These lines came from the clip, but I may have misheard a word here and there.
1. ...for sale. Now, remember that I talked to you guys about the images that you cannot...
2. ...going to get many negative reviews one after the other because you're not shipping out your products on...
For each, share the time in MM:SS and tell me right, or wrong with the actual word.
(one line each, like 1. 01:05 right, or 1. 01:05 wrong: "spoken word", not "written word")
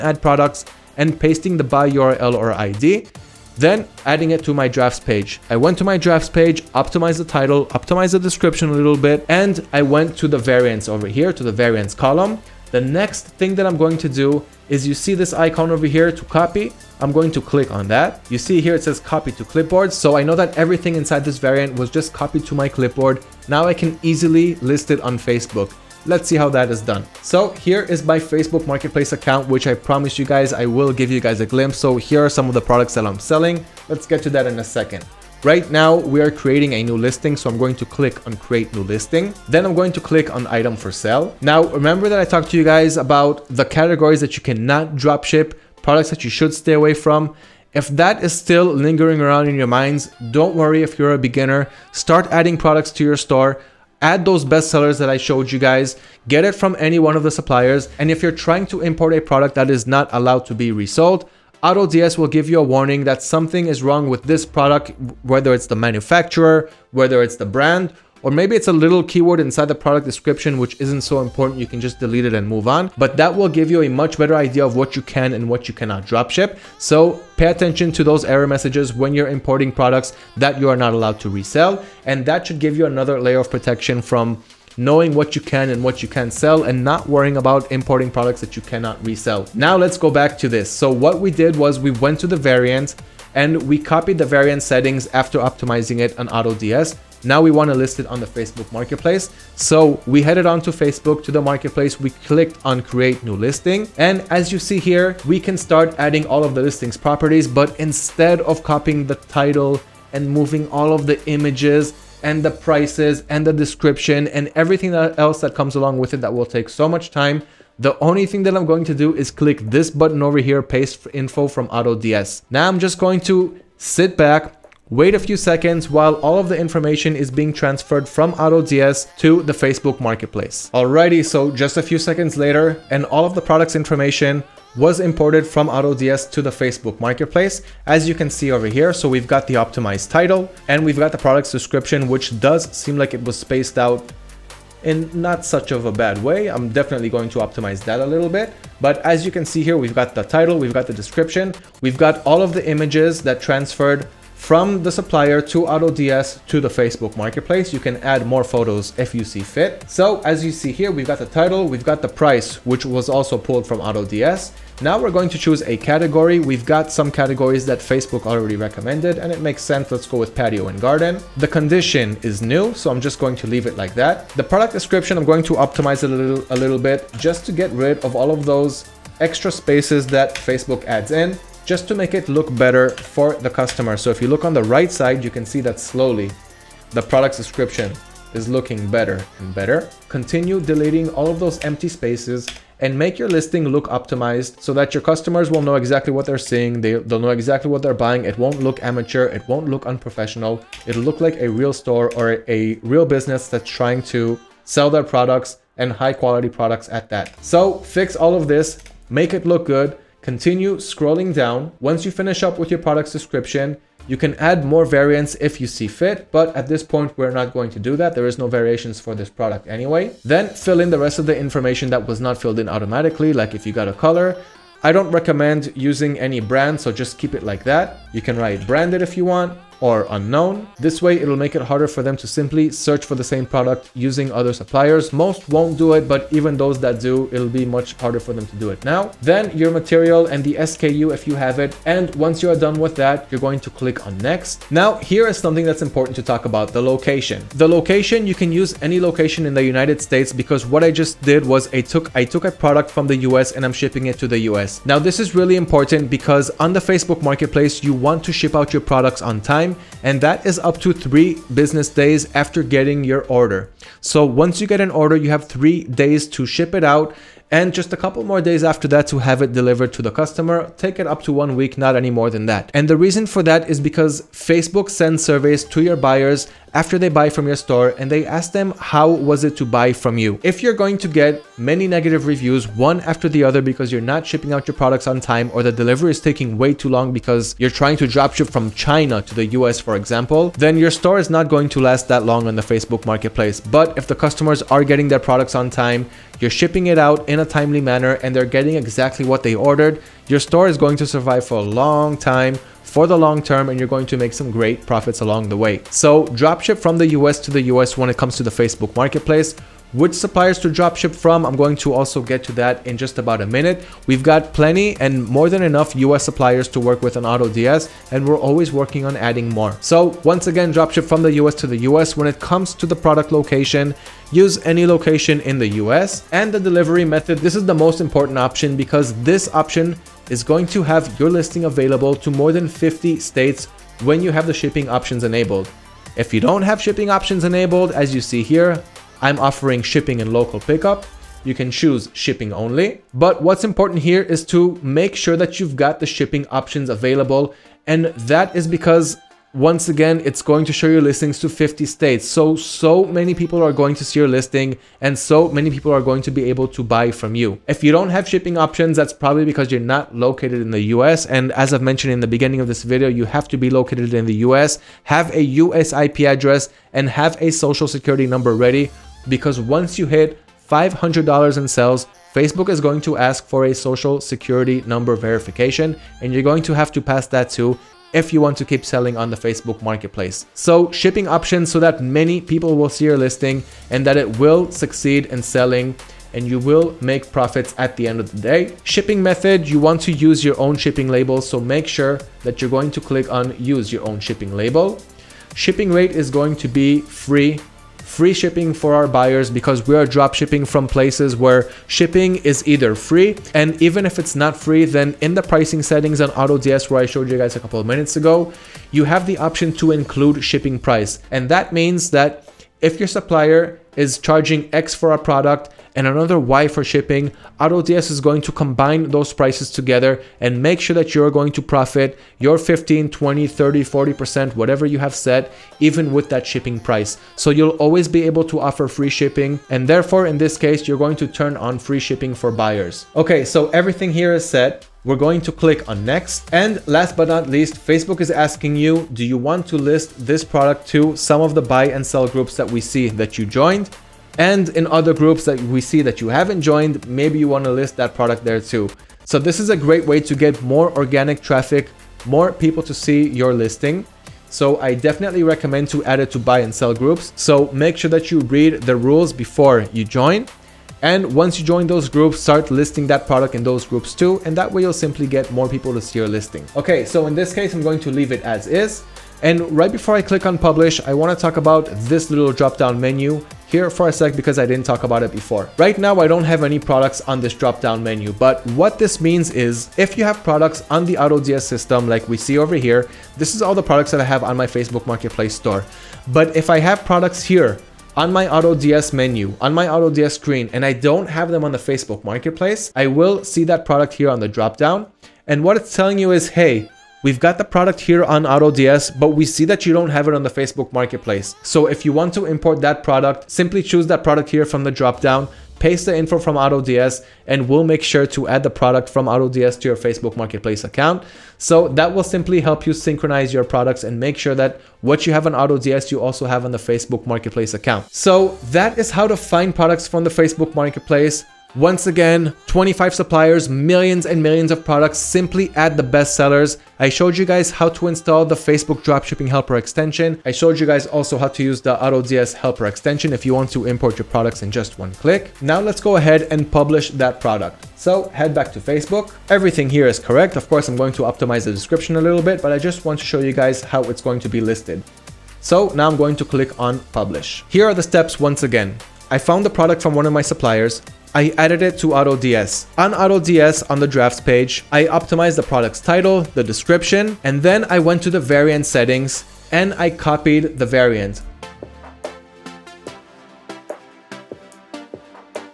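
1. 00:40 wrong: "categories", not "images"
2. 04:40 right.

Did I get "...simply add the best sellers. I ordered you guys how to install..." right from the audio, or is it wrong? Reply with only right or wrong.
wrong.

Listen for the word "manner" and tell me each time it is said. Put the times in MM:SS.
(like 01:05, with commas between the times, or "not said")
04:57.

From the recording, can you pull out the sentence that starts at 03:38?
There is no variations for this product anyway.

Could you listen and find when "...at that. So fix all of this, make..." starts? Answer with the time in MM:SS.
03:26.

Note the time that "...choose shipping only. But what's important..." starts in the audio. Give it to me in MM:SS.
05:41.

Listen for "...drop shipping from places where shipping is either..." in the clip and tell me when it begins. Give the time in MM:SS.
06:40.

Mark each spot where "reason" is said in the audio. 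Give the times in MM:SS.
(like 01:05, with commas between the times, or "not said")
04:32.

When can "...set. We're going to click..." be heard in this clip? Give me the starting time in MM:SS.
07:14.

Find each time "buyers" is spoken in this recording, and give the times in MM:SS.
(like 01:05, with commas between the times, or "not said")
04:35, 06:39, 07:12.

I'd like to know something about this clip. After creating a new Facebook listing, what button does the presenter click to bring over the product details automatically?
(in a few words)
Paste info from AutoDS.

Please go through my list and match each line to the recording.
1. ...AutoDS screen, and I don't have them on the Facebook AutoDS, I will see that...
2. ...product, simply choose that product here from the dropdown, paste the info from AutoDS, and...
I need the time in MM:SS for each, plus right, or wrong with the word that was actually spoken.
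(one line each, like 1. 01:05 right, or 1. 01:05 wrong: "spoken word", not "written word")
1. 08:09 wrong: "Marketplace", not "AutoDS"
2. 08:23 right.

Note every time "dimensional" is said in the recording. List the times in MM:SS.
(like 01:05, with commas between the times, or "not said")
not said.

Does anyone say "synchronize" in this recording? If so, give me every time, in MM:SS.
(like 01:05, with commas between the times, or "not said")
08:32.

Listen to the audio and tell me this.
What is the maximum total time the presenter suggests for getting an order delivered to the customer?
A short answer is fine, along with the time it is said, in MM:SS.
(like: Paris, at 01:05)
1 week, at 04:31.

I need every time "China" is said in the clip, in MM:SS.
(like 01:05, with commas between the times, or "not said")
04:48.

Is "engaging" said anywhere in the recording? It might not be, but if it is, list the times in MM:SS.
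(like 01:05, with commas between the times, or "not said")
not said.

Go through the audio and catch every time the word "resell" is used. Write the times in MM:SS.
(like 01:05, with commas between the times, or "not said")
01:21, 01:29.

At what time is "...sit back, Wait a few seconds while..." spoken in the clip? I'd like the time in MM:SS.
02:03.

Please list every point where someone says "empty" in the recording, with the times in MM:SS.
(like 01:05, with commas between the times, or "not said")
03:11.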